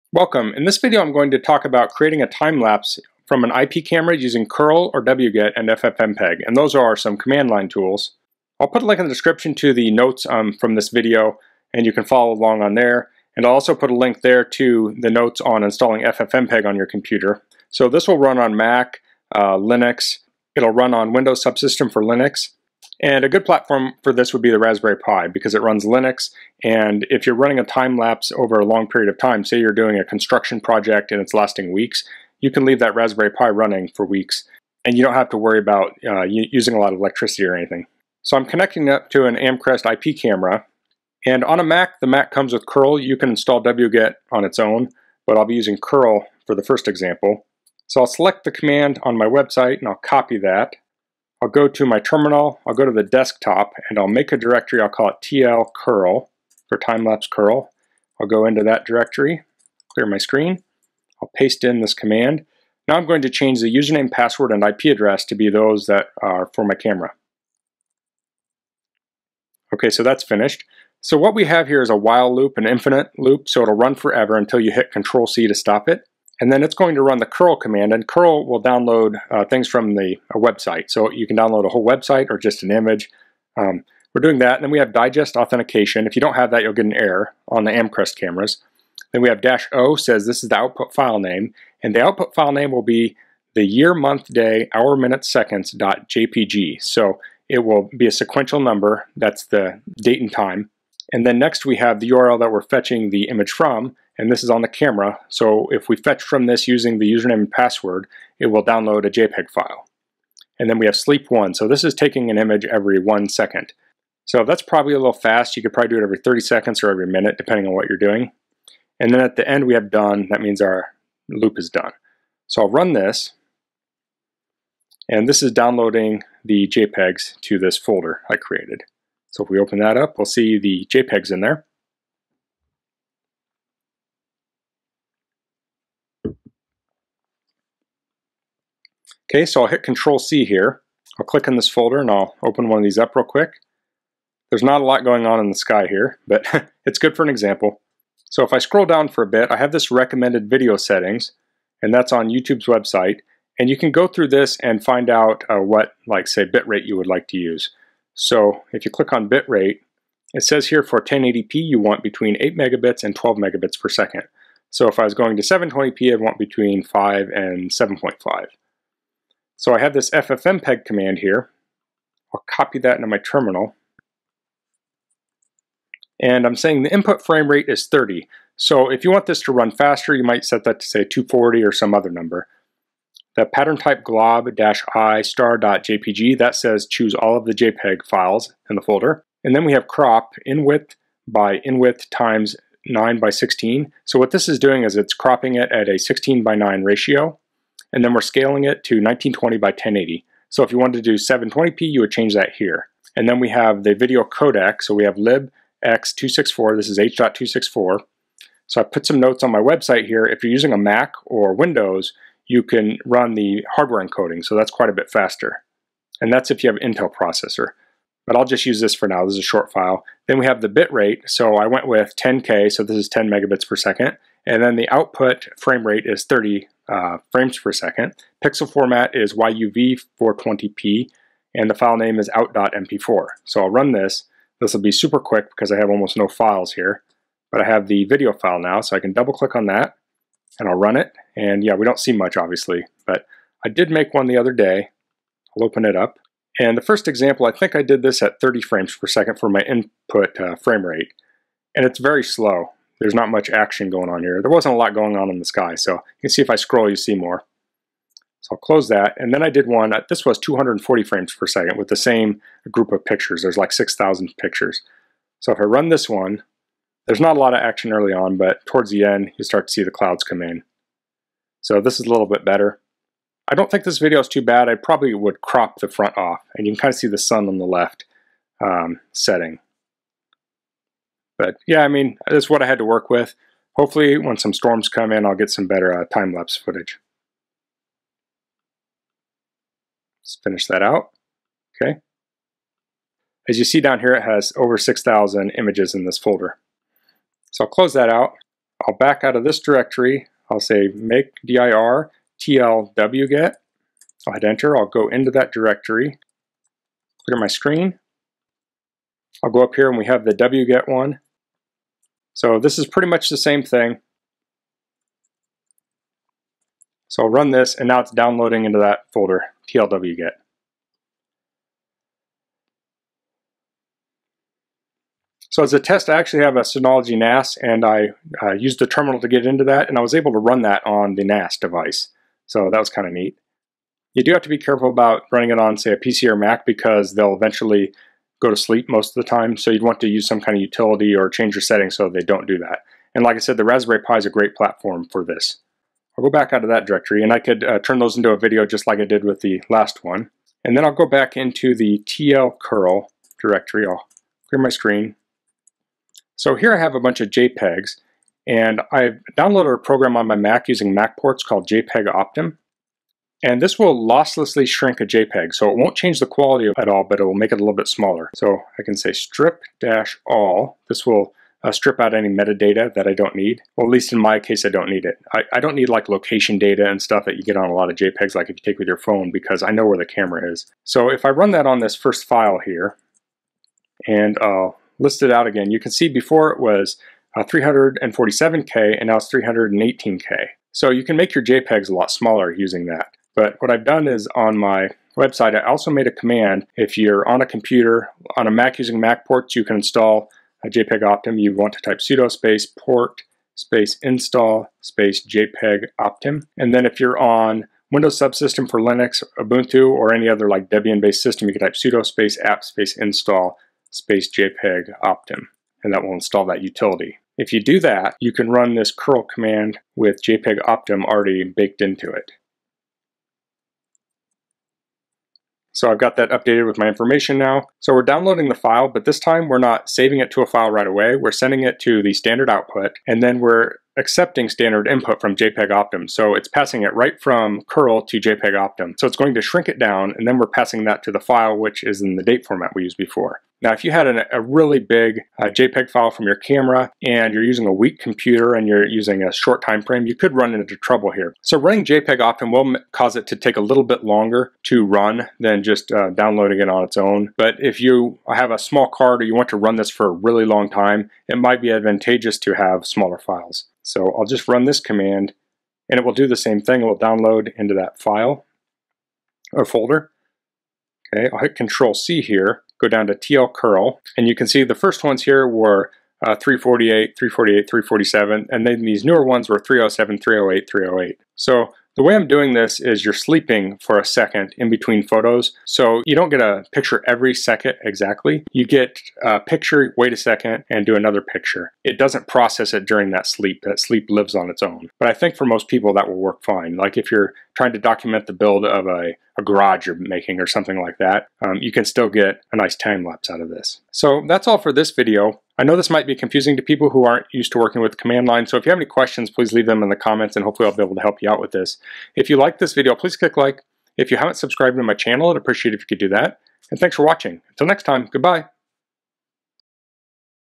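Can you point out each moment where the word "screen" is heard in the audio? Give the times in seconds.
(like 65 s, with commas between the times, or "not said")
60 s, 307 s, 354 s.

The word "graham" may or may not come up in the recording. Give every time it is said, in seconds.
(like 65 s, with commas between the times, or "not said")
not said.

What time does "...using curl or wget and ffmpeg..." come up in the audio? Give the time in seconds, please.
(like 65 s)
4 s.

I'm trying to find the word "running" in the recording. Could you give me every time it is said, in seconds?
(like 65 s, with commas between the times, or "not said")
27 s, 33 s, 335 s, 451 s.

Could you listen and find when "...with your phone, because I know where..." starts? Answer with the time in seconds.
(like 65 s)
378 s.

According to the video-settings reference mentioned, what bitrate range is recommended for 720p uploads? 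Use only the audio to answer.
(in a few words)
5 and 7.5.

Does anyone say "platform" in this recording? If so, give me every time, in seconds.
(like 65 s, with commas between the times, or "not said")
23 s, 344 s.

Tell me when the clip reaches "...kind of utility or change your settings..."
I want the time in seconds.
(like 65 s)
340 s.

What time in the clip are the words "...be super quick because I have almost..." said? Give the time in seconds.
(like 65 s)
234 s.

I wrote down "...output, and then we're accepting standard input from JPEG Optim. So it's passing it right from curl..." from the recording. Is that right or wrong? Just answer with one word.
right.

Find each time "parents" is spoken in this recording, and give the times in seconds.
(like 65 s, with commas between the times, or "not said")
not said.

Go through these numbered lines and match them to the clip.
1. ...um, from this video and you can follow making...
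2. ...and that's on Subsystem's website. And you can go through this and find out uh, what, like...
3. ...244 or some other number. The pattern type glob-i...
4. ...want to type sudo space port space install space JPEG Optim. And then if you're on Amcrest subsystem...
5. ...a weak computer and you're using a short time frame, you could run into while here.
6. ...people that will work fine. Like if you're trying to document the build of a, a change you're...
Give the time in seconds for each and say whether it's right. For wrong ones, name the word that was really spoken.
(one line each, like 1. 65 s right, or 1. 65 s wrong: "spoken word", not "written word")
1. 10 s wrong: "along", not "making"
2. 151 s wrong: "YouTube", not "Subsystem"
3. 181 s wrong: "240", not "244"
4. 401 s wrong: "Windows", not "Amcrest"
5. 447 s wrong: "trouble", not "while"
6. 495 s wrong: "garage", not "change".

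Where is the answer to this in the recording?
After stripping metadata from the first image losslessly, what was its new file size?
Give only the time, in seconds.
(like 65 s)
389 s.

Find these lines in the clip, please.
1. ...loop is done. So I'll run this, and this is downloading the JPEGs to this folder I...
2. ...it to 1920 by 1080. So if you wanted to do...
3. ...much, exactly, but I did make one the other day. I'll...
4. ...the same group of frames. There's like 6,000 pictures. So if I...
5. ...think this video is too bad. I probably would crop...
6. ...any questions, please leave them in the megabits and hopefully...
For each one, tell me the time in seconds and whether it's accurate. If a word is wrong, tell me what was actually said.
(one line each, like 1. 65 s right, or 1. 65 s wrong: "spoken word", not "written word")
1. 121 s right
2. 198 s right
3. 242 s wrong: "obviously", not "exactly"
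4. 261 s wrong: "pictures", not "frames"
5. 273 s right
6. 508 s wrong: "comments", not "megabits".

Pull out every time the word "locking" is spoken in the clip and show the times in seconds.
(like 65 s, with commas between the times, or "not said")
not said.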